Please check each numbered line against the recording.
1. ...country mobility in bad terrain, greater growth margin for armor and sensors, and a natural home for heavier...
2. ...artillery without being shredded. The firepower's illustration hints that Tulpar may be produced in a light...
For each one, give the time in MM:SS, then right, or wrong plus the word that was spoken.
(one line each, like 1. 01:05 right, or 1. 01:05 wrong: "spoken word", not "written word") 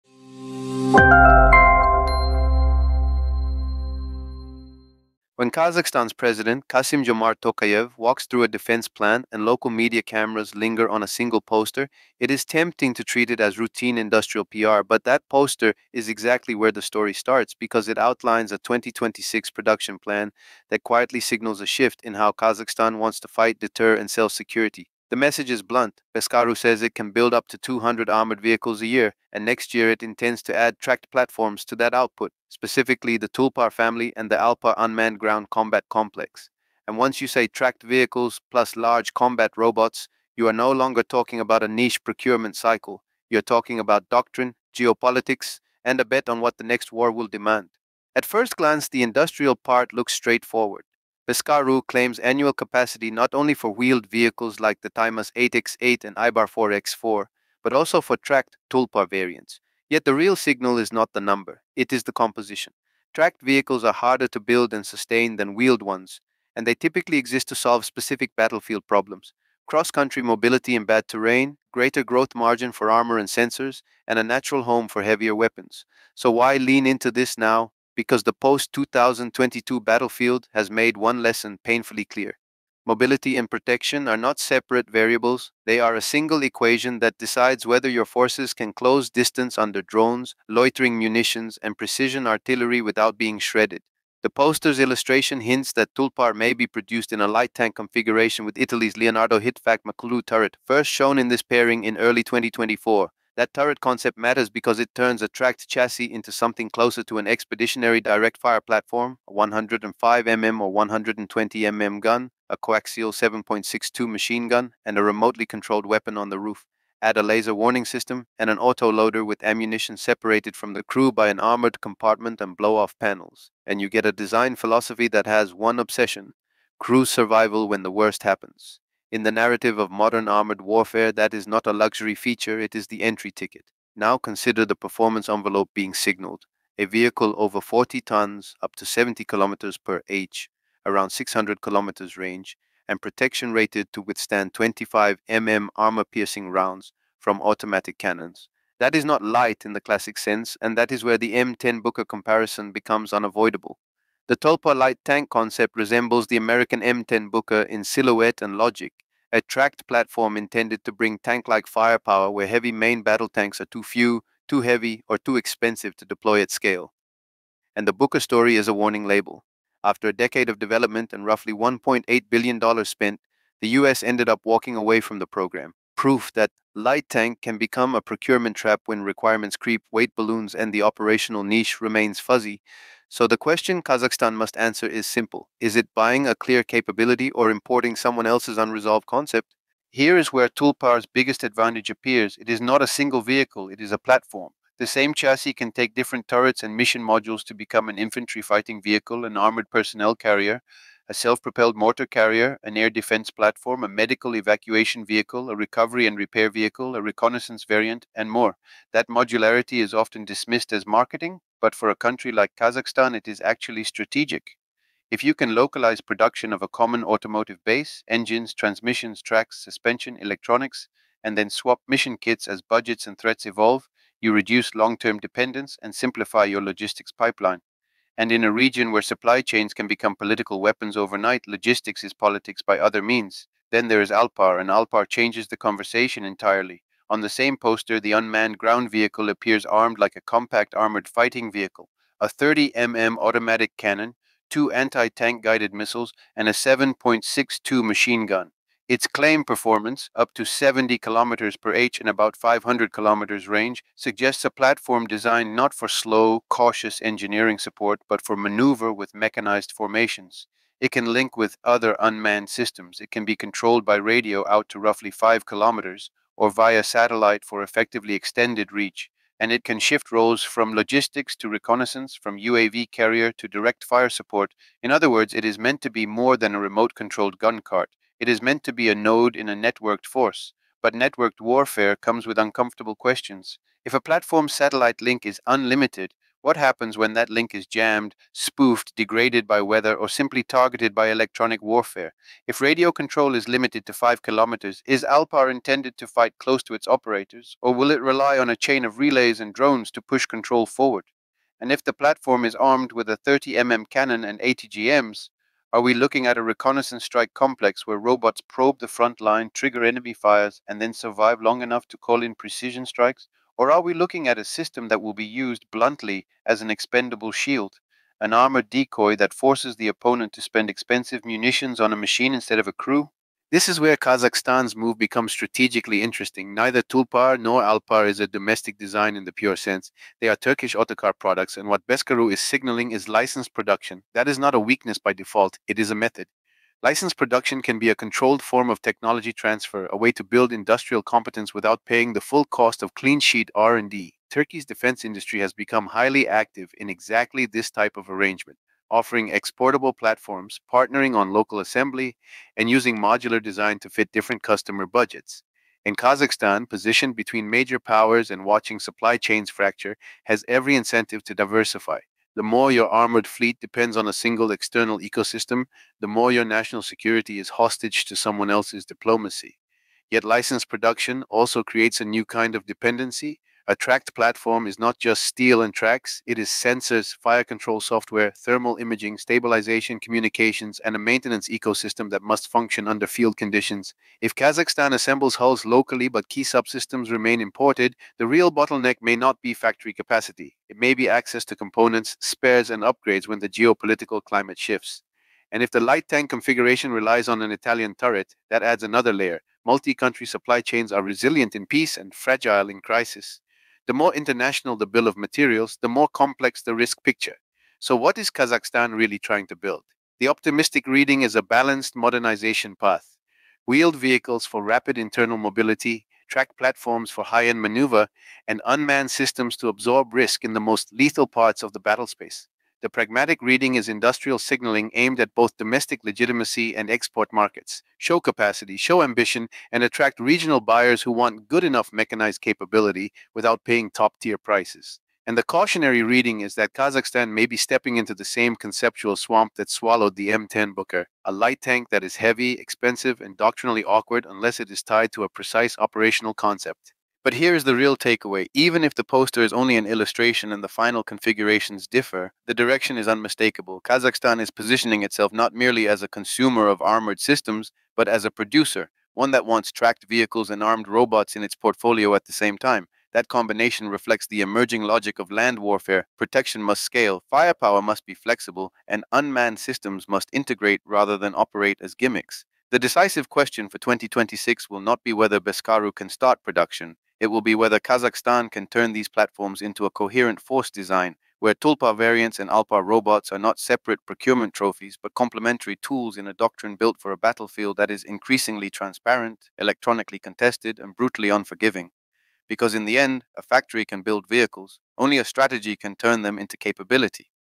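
1. 01:09 right
2. 01:32 wrong: "poster", not "firepower".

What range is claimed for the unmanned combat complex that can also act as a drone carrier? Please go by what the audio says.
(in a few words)
500 kilometers.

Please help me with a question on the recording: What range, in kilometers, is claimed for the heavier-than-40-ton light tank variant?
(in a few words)
600 kilometers.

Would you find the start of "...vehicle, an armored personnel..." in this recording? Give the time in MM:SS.
03:18.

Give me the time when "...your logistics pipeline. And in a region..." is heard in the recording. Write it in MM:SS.
03:46.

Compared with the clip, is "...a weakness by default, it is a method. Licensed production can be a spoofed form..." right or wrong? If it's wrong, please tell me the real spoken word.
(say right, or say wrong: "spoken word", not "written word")
wrong: "controlled", not "spoofed".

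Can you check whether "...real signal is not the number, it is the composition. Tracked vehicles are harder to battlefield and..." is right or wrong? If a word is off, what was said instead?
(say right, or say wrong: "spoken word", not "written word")
wrong: "build", not "battlefield".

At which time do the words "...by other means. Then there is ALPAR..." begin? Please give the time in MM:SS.
03:52.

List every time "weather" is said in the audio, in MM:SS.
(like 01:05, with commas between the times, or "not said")
04:49.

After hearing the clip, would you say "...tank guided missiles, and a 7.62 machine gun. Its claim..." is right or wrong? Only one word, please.
right.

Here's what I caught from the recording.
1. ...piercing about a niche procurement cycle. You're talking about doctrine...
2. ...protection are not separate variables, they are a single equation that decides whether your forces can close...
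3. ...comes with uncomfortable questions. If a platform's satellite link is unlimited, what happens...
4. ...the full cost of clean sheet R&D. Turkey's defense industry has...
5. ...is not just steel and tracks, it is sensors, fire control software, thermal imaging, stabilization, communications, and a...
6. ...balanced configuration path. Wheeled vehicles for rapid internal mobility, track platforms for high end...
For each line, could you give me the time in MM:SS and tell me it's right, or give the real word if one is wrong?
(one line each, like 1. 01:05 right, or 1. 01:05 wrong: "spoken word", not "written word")
1. 00:41 wrong: "talking", not "piercing"
2. 01:23 right
3. 04:41 right
4. 05:42 right
5. 06:14 right
6. 06:51 wrong: "modernization", not "configuration".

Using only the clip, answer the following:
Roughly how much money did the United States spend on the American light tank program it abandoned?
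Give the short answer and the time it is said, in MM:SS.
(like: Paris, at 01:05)
$1.8 billion, at 02:51.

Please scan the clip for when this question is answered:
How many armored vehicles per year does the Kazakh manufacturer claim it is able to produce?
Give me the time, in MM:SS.
00:27.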